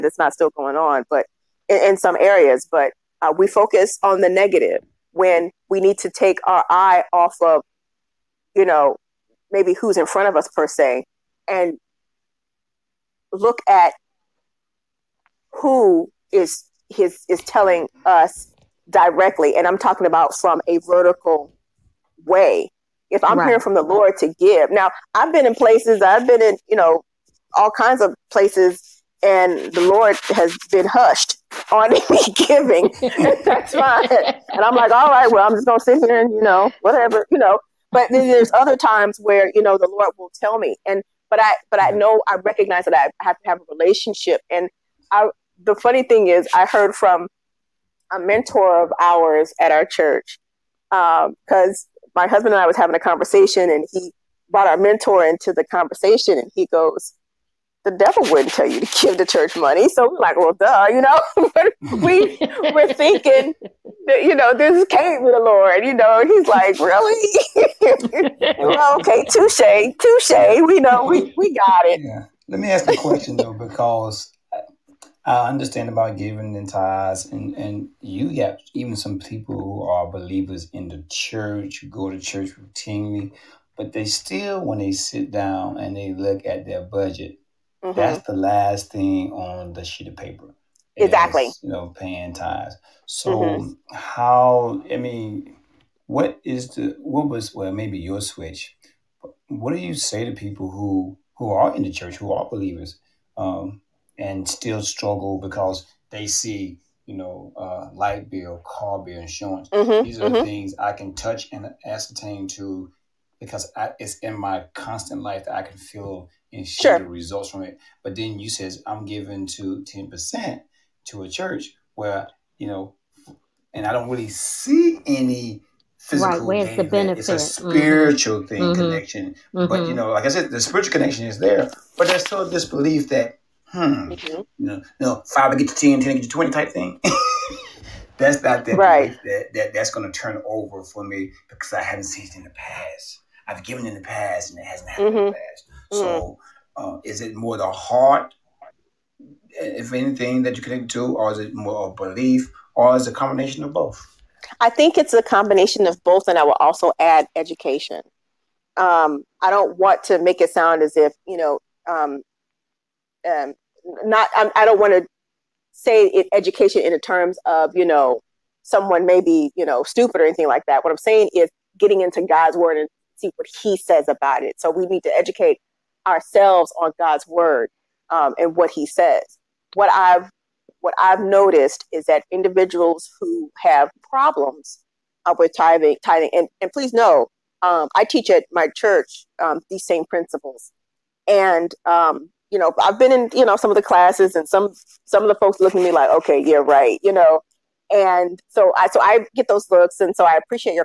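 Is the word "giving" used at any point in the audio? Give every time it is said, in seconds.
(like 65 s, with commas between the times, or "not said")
32 s, 76 s, 119 s.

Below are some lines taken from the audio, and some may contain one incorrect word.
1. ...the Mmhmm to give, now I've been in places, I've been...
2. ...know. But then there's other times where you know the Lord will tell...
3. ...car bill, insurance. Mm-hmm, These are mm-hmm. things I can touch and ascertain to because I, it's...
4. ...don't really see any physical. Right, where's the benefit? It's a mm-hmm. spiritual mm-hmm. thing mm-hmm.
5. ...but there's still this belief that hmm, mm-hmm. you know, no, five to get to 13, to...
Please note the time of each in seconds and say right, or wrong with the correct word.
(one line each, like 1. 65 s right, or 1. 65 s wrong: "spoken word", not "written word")
1. 23 s wrong: "Lord", not "Mmhmm"
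2. 37 s right
3. 108 s right
4. 123 s right
5. 131 s wrong: "10", not "13".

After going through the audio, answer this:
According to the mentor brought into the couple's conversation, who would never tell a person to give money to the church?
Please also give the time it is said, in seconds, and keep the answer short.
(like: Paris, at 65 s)
The devil, at 57 s.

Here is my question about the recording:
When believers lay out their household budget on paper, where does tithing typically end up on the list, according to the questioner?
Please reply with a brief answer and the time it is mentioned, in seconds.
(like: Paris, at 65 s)
The last thing, at 88 s.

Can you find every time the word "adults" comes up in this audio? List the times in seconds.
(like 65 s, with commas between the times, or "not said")
not said.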